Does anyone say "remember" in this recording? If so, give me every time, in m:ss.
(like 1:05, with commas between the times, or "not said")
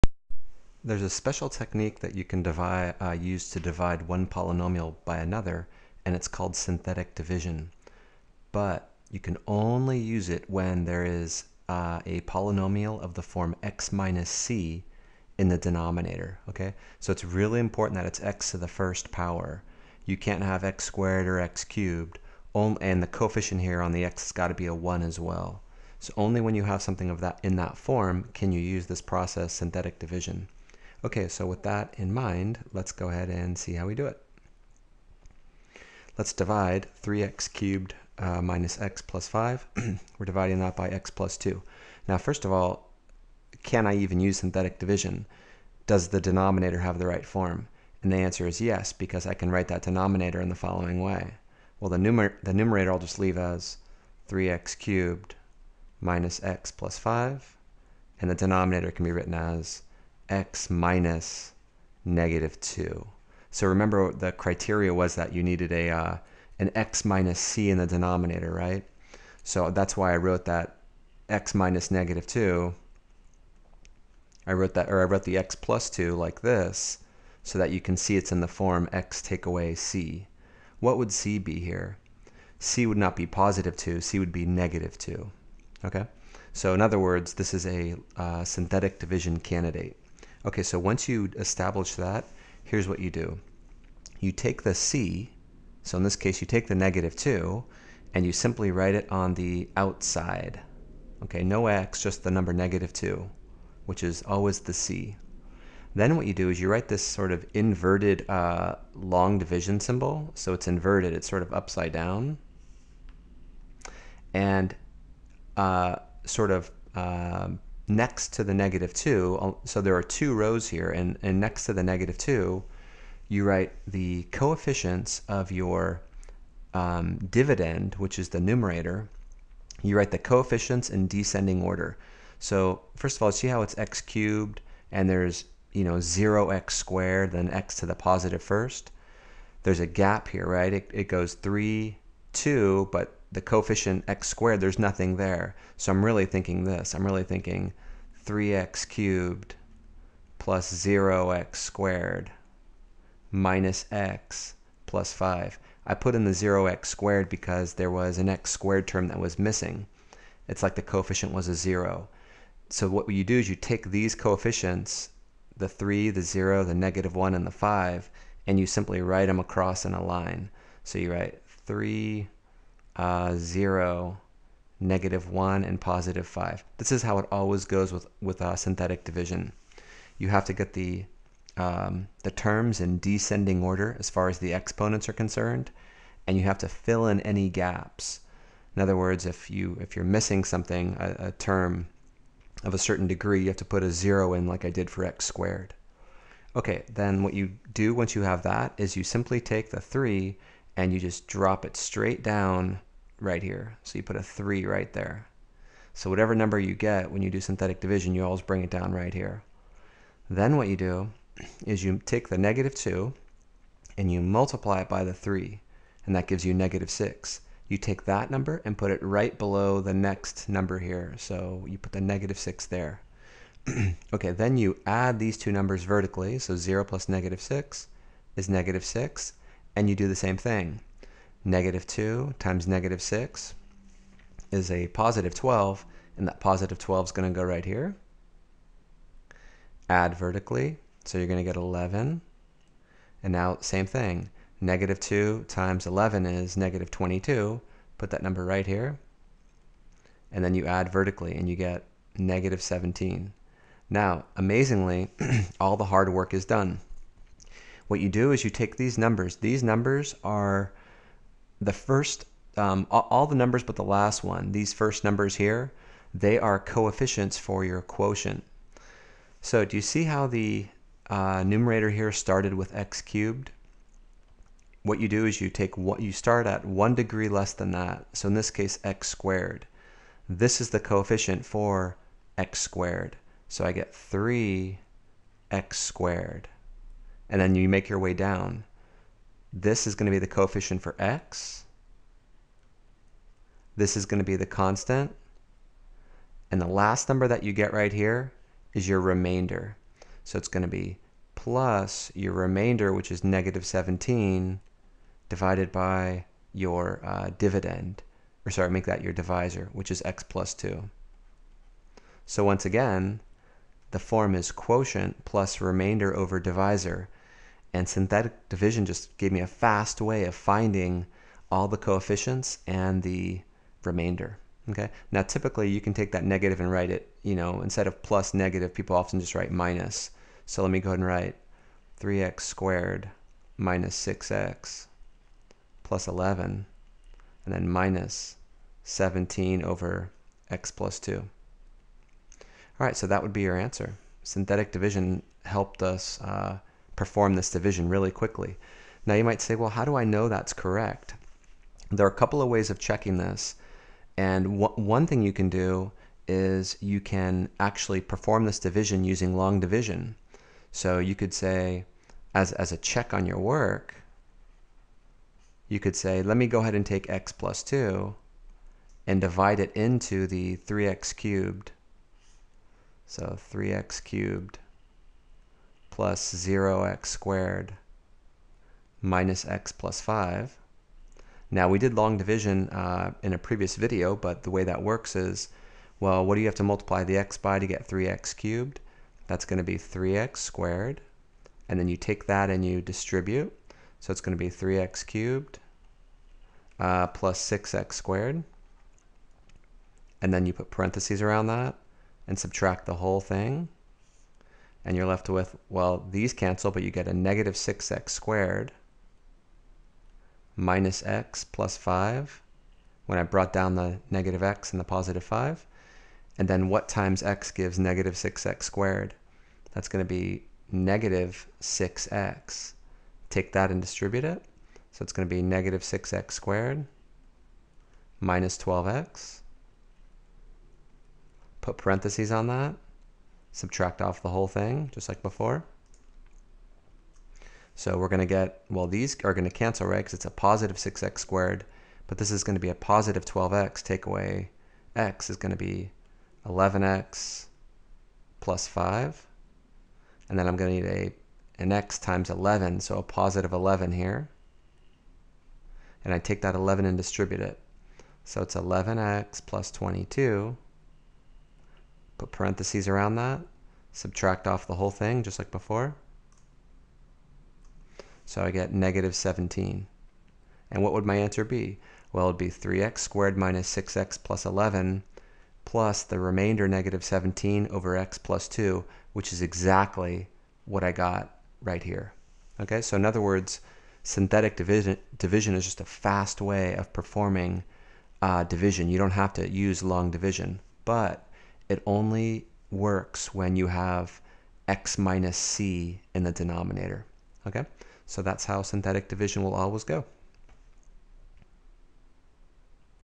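1:03.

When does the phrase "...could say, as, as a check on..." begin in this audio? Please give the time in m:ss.
6:01.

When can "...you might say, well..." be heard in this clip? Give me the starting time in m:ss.
5:49.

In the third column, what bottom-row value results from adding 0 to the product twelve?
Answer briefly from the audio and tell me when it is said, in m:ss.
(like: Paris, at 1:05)
11, at 4:01.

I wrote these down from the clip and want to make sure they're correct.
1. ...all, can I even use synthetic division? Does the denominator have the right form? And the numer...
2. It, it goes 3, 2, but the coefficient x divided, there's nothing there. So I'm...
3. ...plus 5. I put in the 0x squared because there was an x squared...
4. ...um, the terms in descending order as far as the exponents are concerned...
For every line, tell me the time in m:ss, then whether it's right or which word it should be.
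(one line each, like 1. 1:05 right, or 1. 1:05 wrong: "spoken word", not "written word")
1. 0:42 wrong: "answer", not "numer"
2. 2:20 wrong: "squared", not "divided"
3. 2:34 right
4. 3:01 right.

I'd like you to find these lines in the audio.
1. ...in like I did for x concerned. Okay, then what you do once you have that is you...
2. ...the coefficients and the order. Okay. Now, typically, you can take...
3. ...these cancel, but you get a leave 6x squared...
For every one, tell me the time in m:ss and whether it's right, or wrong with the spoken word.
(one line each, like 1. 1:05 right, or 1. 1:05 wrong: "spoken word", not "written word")
1. 3:14 wrong: "squared", not "concerned"
2. 5:21 wrong: "remainder", not "order"
3. 6:46 wrong: "negative", not "leave".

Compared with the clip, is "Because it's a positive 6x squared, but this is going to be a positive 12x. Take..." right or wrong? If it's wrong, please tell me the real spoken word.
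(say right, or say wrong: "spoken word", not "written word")
right.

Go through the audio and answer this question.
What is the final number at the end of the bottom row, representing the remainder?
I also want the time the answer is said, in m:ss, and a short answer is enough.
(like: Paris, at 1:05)
-17, at 4:11.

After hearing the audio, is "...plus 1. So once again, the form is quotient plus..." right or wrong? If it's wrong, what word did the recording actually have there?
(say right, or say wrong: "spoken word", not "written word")
wrong: "2", not "1".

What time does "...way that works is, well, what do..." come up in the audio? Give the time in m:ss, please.
6:24.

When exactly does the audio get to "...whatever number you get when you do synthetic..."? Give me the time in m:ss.
3:26.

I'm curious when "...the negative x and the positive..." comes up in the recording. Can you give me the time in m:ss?
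6:53.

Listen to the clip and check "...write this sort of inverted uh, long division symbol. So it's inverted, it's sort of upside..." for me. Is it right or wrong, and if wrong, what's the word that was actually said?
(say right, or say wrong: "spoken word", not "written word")
right.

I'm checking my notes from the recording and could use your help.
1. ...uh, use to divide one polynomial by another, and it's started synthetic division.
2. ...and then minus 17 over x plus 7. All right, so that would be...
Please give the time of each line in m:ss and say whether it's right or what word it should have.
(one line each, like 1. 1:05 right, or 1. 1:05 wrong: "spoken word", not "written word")
1. 0:02 wrong: "called", not "started"
2. 5:37 wrong: "2", not "7".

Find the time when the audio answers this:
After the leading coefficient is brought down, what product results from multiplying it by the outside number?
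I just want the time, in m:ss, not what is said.
3:36.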